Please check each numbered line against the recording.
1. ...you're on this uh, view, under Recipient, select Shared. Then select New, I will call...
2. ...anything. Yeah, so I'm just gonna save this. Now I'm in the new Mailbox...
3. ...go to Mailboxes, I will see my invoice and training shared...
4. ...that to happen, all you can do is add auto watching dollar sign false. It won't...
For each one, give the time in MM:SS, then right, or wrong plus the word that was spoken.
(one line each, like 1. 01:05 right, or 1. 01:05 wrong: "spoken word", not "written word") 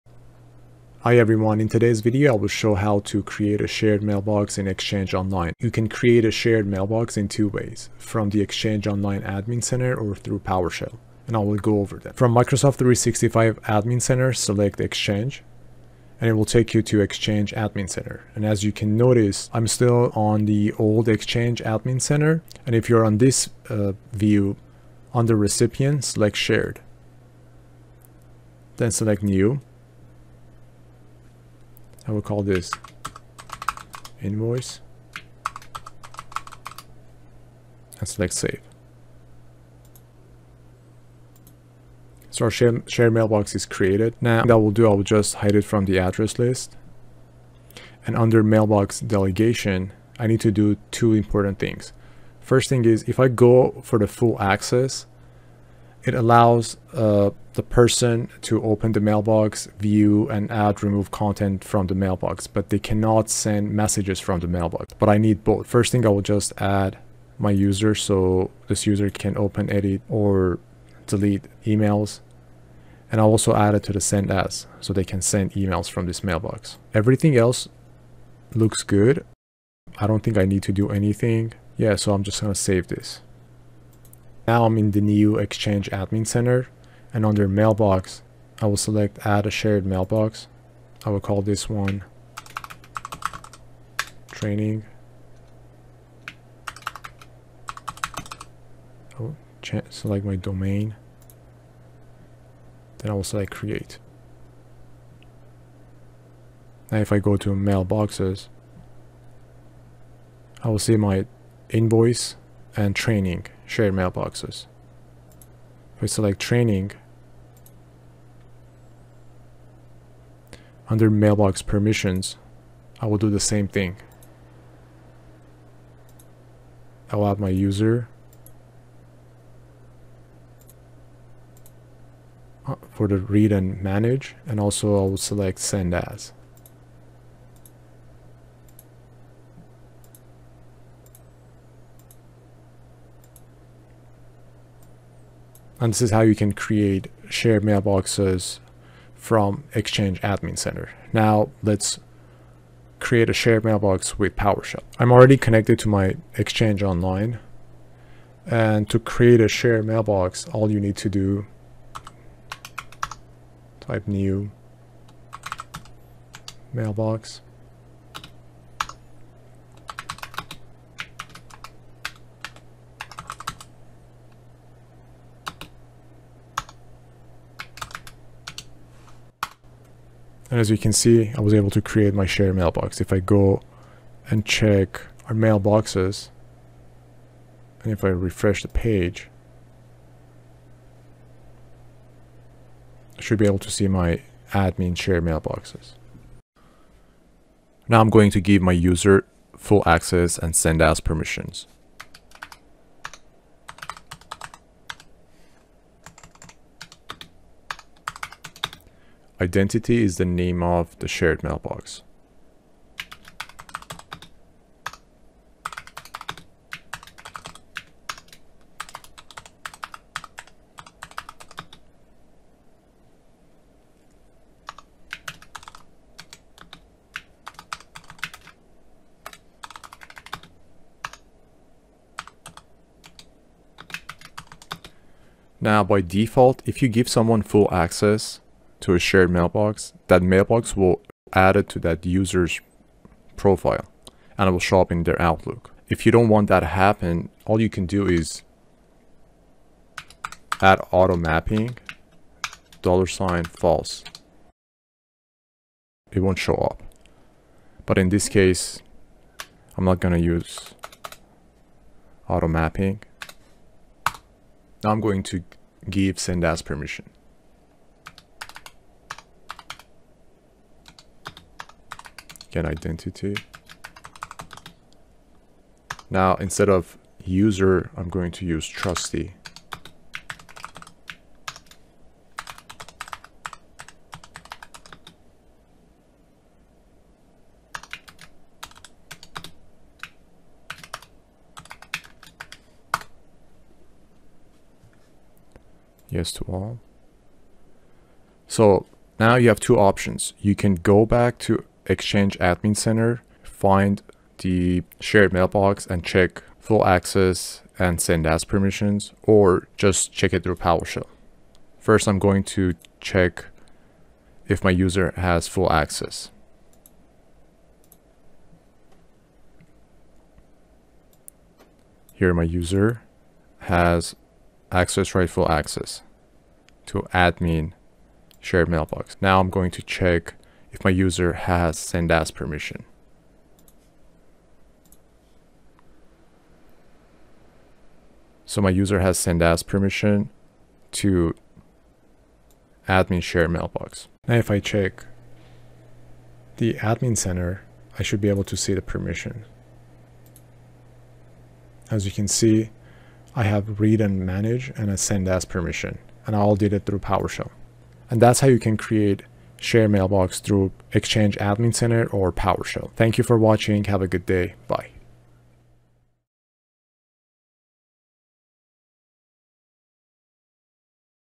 1. 00:22 right
2. 01:20 wrong: "Exchange", not "Mailbox"
3. 01:47 right
4. 04:06 wrong: "mapping", not "watching".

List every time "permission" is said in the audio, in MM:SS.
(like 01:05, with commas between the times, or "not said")
02:01, 03:20, 04:26, 05:08, 05:32, 05:39, 05:48, 05:55.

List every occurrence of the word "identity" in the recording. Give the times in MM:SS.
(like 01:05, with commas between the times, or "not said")
03:29, 04:32.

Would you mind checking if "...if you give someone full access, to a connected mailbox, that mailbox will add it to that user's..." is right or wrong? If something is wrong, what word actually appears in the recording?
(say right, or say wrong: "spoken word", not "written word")
wrong: "shared", not "connected".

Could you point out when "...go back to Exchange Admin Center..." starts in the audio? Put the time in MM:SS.
05:00.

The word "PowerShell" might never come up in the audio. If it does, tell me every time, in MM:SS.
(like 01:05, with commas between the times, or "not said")
00:10, 02:34, 05:10, 05:56, 06:02.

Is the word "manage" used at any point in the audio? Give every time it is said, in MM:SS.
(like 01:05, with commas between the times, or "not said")
02:13, 05:54.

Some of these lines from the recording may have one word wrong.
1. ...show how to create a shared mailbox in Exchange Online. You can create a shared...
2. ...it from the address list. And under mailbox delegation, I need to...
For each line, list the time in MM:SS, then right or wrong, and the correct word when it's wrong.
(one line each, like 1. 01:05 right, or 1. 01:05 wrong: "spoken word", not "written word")
1. 00:02 right
2. 00:45 right.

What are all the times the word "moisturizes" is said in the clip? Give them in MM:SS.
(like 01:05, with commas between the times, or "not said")
not said.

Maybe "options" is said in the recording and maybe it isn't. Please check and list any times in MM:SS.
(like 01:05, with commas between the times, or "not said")
04:59.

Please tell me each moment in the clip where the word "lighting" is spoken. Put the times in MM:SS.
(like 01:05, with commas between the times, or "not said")
not said.